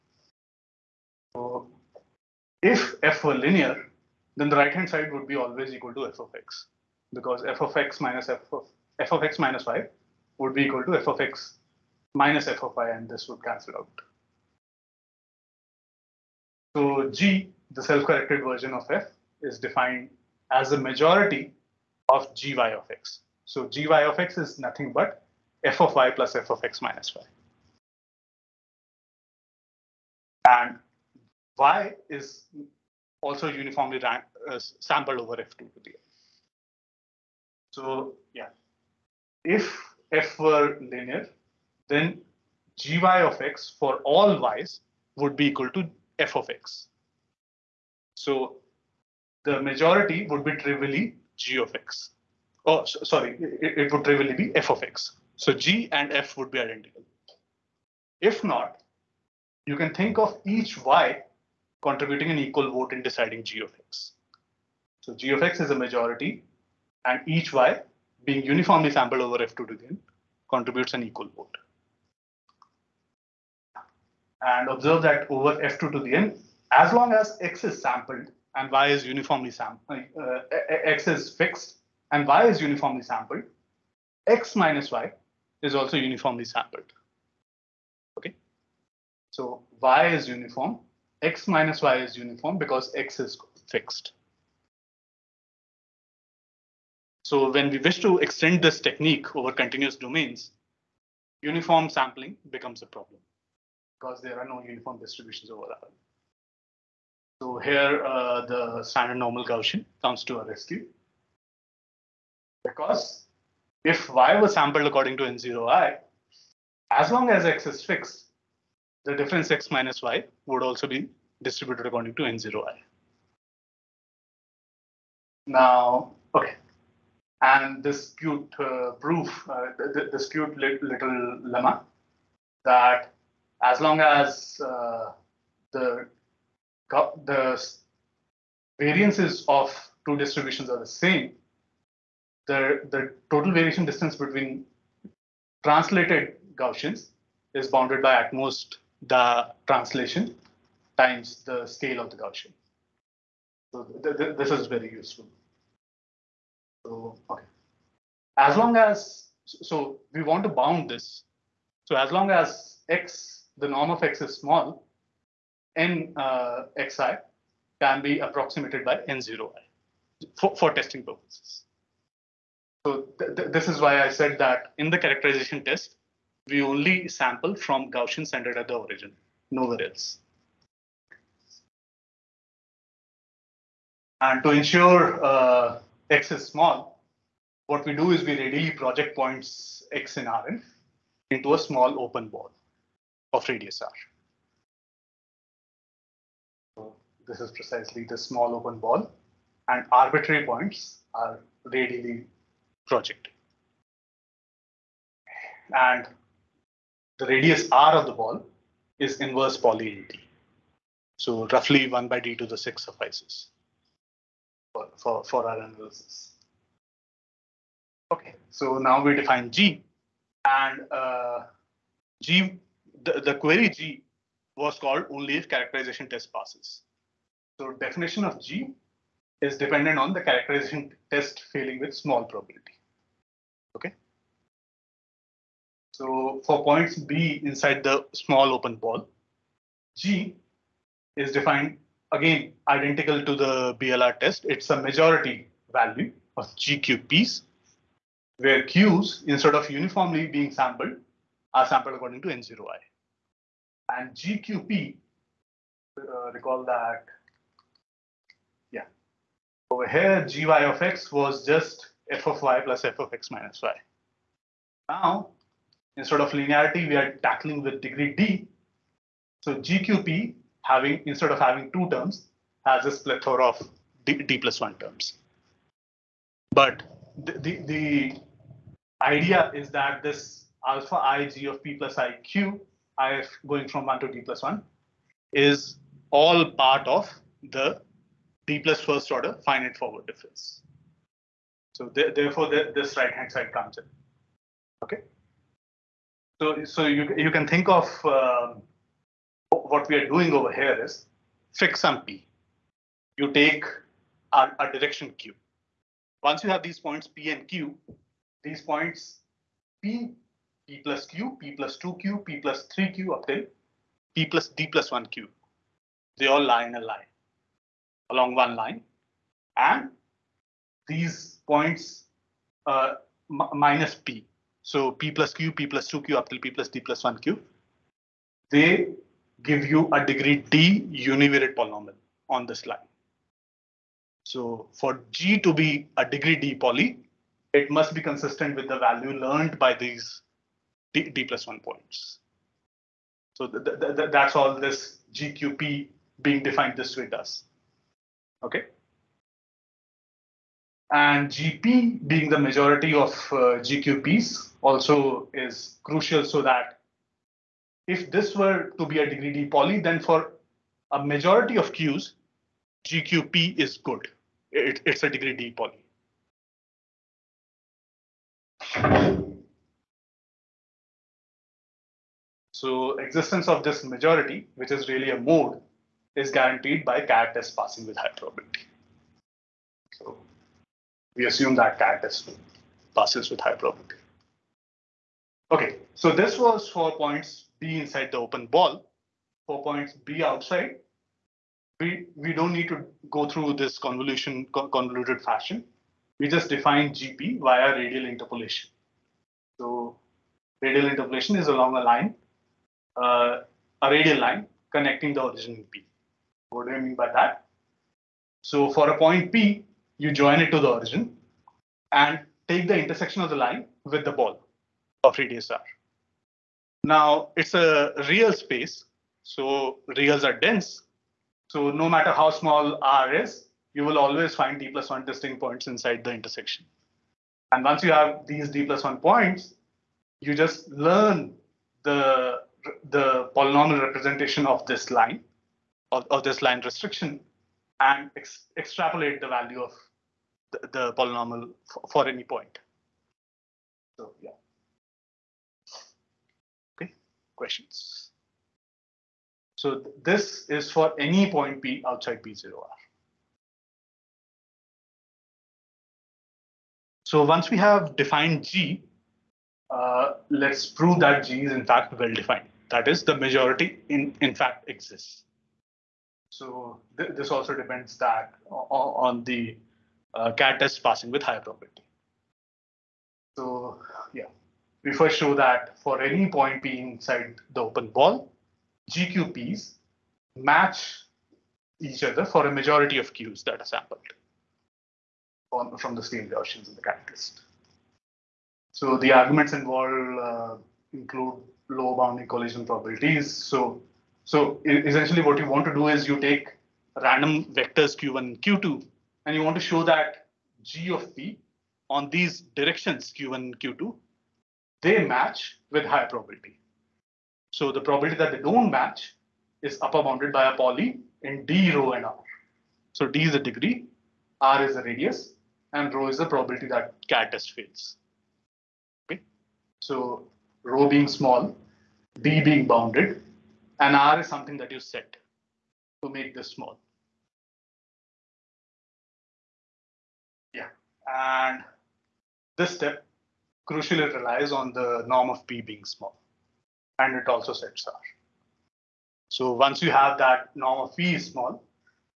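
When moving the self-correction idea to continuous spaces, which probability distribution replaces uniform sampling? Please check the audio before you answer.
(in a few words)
Standard normal Gaussian.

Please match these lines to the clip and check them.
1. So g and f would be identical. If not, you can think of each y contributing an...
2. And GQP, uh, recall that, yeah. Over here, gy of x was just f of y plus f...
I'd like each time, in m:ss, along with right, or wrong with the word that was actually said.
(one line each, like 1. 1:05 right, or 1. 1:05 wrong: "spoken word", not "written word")
1. 0:55 right
2. 4:13 right.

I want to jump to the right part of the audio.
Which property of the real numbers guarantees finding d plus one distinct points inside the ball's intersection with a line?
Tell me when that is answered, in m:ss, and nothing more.
6:59.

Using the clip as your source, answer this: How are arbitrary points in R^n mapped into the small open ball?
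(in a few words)
Radially projected.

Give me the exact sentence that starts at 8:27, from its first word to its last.
So the probability that they don't match is upper bounded by a poly in D, rho, and R.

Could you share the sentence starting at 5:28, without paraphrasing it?
They give you a degree D univariate polynomial on this line.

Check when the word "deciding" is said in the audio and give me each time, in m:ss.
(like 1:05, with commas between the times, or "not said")
1:03.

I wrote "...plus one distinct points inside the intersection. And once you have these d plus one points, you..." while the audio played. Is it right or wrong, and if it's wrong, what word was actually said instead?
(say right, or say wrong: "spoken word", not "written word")
right.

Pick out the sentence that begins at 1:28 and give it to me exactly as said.
Okay, so y is uniform, x minus y is uniform because x is fixed.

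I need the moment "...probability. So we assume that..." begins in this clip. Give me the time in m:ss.
6:18.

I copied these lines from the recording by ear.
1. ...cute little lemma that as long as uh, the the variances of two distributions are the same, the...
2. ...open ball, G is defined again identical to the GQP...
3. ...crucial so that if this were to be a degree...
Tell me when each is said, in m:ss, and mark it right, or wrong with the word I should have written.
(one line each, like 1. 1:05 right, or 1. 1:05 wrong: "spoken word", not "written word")
1. 2:10 right
2. 3:58 wrong: "BLR", not "GQP"
3. 5:55 right.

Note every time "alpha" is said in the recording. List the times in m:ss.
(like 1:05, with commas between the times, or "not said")
4:40.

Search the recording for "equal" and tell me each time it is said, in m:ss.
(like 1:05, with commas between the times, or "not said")
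0:05, 0:10, 0:45, 1:02, 1:11.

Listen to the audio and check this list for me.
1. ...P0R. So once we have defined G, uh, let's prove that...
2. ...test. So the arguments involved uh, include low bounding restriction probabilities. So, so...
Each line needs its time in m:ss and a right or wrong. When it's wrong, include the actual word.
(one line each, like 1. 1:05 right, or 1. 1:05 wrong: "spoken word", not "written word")
1. 7:32 right
2. 8:07 wrong: "collision", not "restriction".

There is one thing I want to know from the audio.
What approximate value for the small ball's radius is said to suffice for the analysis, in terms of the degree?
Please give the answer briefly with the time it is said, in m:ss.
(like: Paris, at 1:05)
1/d^6, at 3:31.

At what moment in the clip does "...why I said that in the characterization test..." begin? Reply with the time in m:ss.
2:53.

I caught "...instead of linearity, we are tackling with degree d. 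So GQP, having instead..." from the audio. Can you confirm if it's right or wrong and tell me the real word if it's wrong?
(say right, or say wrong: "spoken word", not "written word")
right.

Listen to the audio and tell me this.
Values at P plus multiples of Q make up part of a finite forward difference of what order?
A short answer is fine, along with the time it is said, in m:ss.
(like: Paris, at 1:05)
d plus first order, at 4:48.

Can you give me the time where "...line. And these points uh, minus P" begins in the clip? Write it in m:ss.
5:18.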